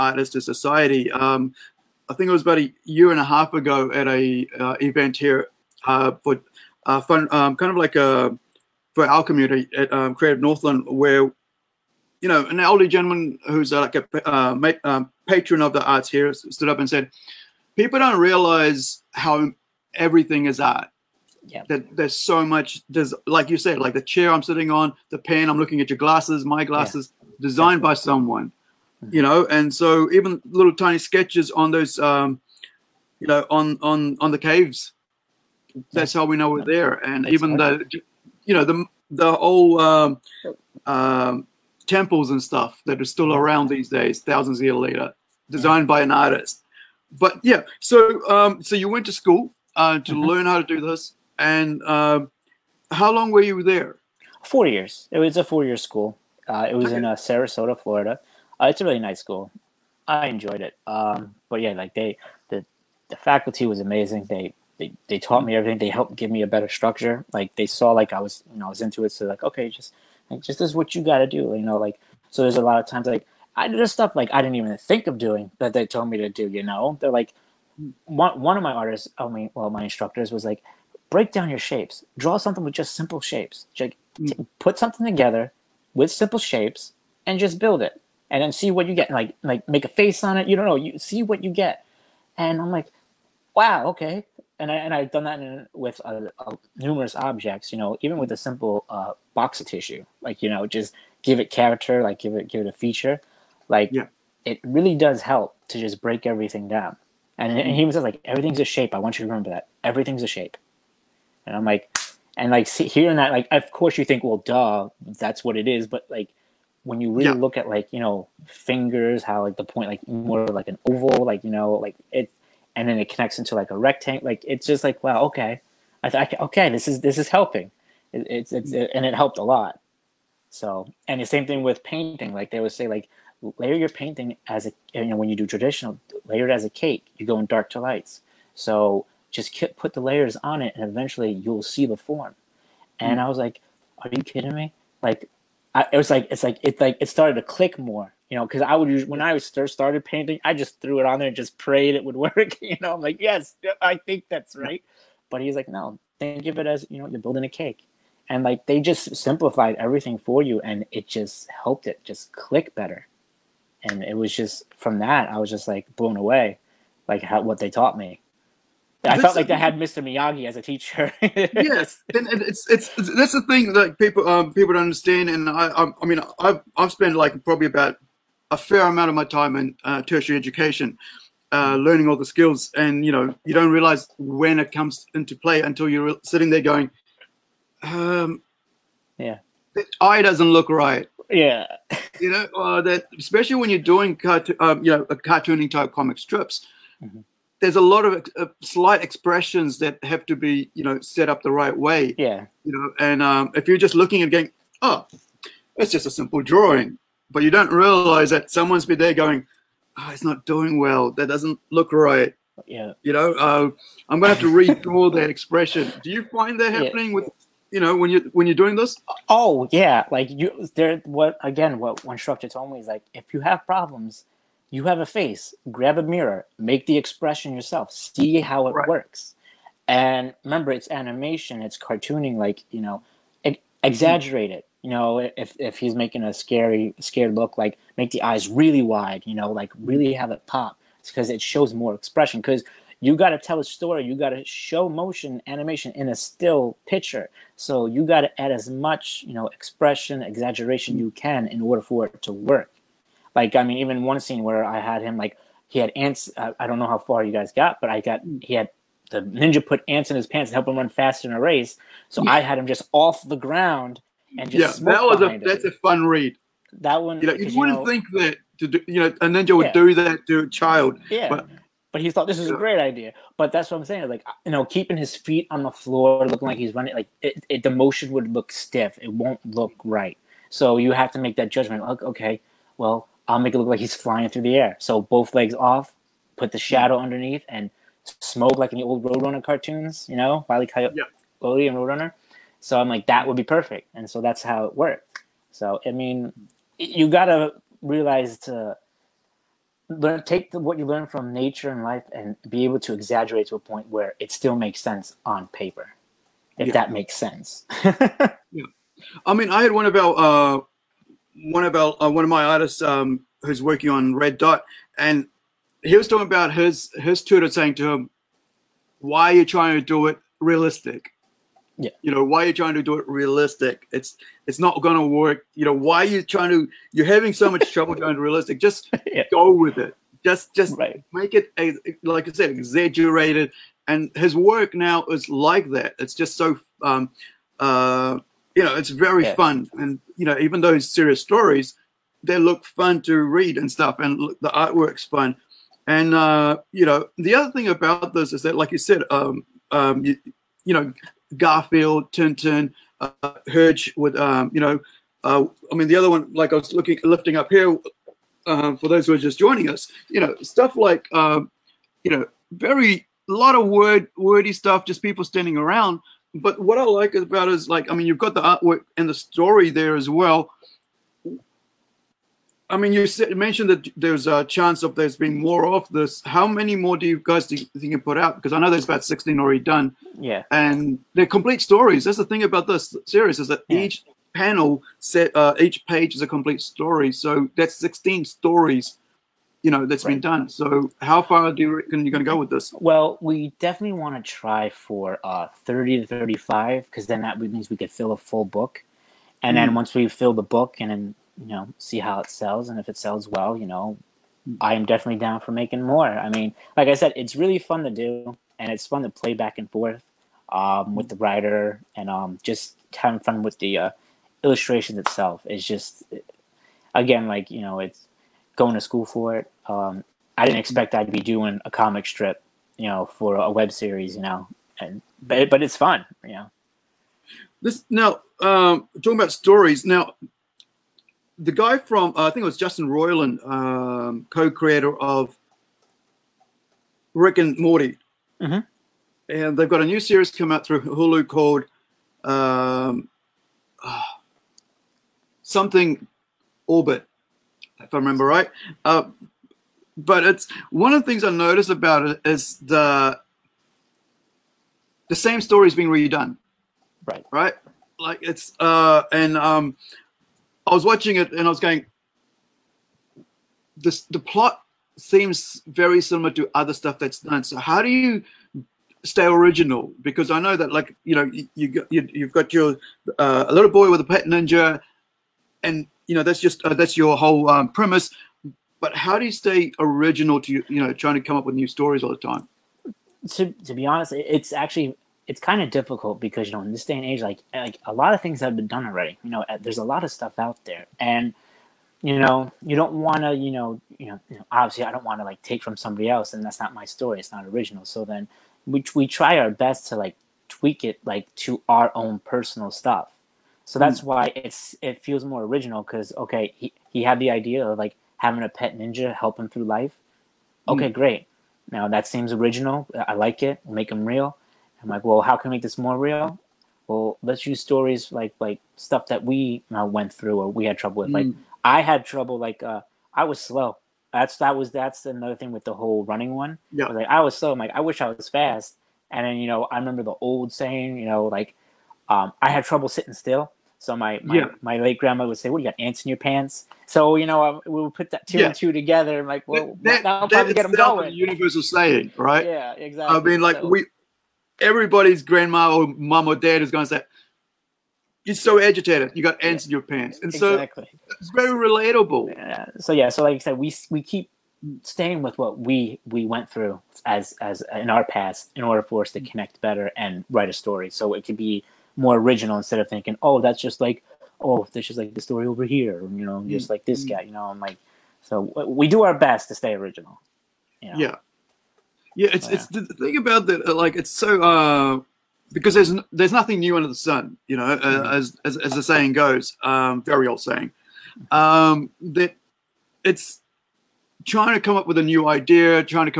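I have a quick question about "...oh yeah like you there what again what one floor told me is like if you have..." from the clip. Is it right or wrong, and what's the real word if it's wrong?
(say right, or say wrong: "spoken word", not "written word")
wrong: "instructor", not "floor".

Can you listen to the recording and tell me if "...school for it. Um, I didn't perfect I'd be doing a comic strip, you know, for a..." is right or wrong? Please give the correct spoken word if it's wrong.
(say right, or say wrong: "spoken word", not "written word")
wrong: "expect", not "perfect".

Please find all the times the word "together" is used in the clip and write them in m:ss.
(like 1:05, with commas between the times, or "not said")
1:25, 8:58.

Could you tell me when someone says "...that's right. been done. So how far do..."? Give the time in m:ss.
6:29.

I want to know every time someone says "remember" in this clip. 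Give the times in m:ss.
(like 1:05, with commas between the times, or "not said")
1:49, 3:50, 7:27, 8:49.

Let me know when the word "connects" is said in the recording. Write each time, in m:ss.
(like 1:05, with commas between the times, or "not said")
2:03, 9:19.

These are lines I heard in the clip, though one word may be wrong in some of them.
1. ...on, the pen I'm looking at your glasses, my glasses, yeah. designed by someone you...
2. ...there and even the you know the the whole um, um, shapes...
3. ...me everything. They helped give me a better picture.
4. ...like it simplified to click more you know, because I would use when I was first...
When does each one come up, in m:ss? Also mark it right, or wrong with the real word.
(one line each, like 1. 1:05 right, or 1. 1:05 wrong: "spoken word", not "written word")
1. 0:24 right
2. 0:36 wrong: "temples", not "shapes"
3. 1:05 wrong: "structure", not "picture"
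4. 2:26 wrong: "started", not "simplified".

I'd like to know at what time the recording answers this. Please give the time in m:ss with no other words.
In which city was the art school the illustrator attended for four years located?
0:57.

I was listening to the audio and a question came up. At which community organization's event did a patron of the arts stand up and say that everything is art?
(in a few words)
Creative Northland.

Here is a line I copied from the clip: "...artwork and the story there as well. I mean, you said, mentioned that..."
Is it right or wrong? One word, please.
right.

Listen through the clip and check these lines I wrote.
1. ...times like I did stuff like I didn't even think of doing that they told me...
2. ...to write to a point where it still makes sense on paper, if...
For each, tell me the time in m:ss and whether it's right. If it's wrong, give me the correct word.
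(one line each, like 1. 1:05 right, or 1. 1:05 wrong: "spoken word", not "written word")
1. 1:12 right
2. 5:02 wrong: "exaggerate", not "write".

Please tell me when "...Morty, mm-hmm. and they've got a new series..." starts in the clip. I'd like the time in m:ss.
7:17.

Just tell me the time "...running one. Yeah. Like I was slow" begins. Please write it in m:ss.
8:46.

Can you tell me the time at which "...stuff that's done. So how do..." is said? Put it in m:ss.
7:46.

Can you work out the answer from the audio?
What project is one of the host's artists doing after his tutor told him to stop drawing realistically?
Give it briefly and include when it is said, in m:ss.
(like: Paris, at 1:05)
Red Dot, at 5:14.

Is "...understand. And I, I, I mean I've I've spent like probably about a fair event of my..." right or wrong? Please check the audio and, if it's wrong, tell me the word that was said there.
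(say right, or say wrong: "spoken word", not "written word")
wrong: "amount", not "event".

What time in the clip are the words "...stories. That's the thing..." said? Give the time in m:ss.
6:21.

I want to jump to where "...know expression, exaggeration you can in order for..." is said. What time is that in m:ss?
4:09.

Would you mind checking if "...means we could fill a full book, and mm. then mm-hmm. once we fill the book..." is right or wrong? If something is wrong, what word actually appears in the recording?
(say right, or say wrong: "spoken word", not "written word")
right.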